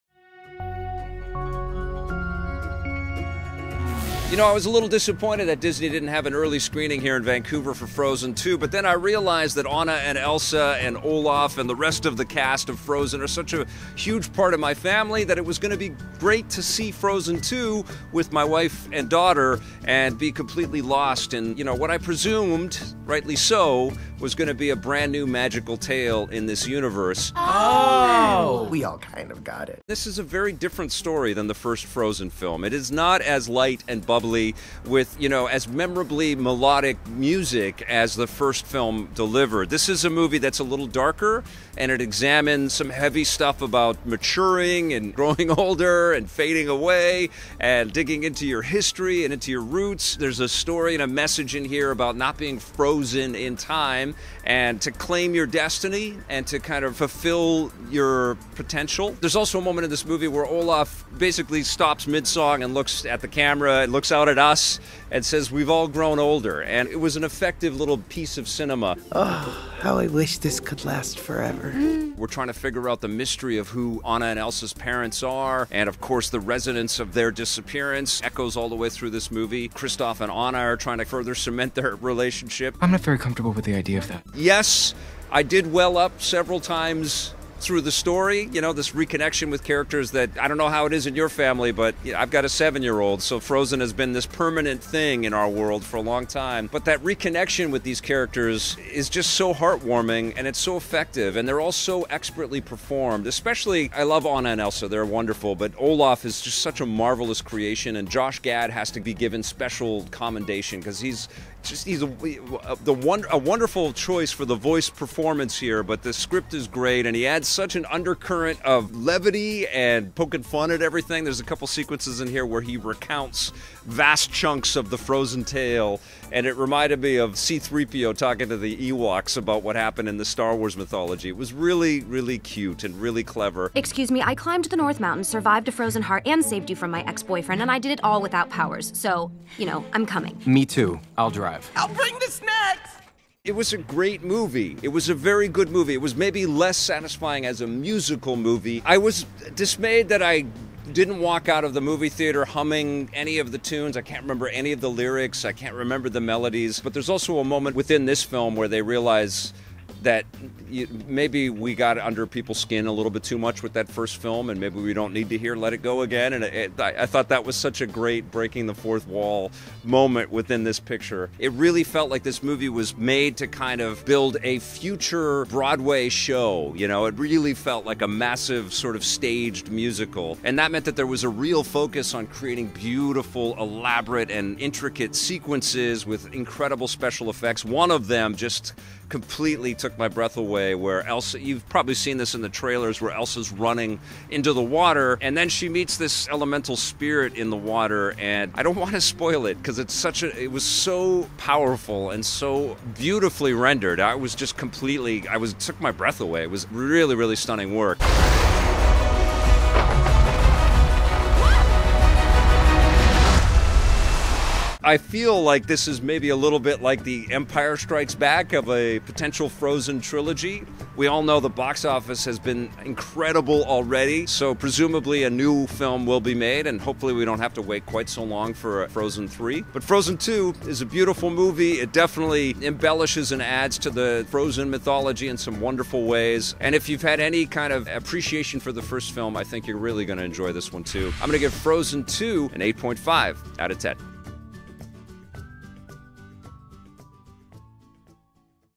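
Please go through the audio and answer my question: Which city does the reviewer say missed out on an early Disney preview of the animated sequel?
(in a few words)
Vancouver.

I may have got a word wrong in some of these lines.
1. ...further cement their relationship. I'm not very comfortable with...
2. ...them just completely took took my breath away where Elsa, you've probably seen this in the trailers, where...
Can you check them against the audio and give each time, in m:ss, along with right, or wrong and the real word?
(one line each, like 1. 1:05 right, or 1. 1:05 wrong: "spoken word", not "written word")
1. 1:21 right
2. 3:08 right.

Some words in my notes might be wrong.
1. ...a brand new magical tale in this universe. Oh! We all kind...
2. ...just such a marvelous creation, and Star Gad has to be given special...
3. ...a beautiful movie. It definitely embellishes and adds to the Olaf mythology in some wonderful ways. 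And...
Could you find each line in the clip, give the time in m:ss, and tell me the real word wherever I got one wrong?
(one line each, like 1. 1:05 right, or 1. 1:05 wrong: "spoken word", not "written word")
1. 0:24 right
2. 1:46 wrong: "Josh", not "Star"
3. 3:50 wrong: "Frozen", not "Olaf".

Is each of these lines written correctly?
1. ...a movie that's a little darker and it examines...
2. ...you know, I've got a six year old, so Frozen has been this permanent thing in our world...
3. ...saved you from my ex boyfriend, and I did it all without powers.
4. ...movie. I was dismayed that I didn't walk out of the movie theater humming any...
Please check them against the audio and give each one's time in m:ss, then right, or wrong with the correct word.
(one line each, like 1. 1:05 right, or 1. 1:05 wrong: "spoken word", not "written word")
1. 0:40 right
2. 1:32 wrong: "seven", not "six"
3. 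2:16 right
4. 2:28 right.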